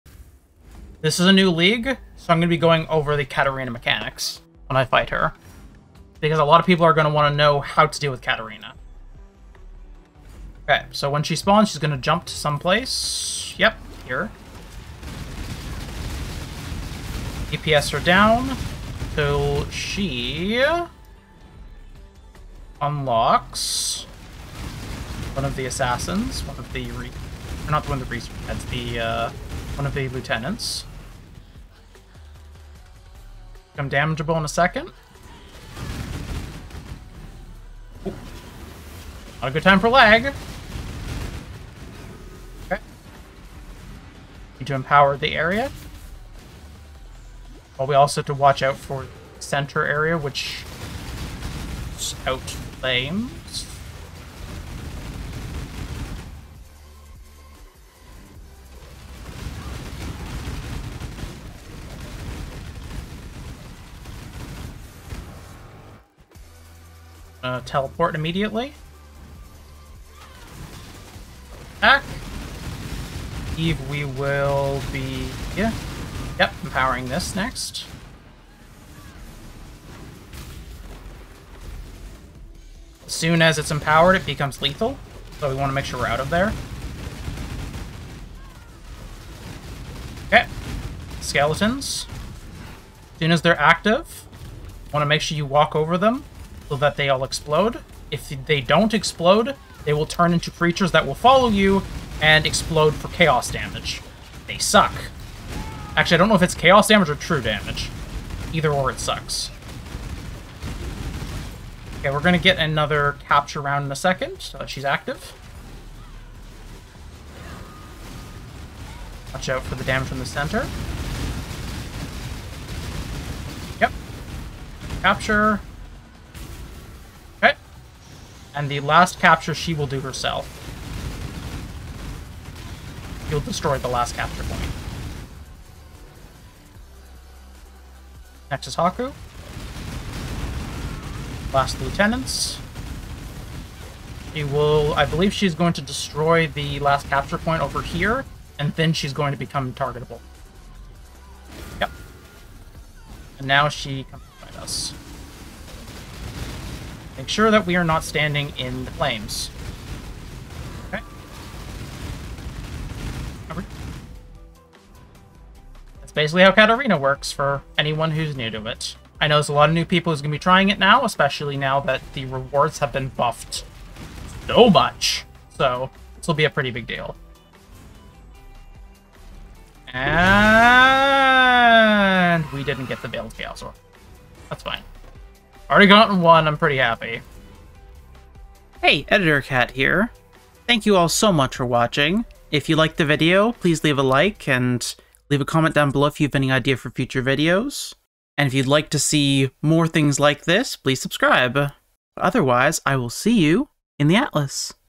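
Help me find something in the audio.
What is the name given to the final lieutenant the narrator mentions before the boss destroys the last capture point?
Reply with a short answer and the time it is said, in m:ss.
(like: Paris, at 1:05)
Haku, at 2:18.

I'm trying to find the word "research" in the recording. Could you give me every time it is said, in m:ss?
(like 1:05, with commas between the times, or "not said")
0:28.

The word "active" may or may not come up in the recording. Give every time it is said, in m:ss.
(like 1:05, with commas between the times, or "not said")
1:33, 1:54.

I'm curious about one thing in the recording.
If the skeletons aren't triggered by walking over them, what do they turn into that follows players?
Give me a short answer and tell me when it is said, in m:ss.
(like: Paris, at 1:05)
creatures, at 1:40.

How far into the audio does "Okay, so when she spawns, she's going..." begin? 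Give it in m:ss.
0:10.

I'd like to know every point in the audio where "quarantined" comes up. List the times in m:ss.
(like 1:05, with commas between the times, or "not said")
not said.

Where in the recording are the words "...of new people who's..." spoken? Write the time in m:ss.
2:49.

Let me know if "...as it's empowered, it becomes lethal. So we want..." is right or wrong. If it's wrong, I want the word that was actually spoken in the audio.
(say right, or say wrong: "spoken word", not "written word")
right.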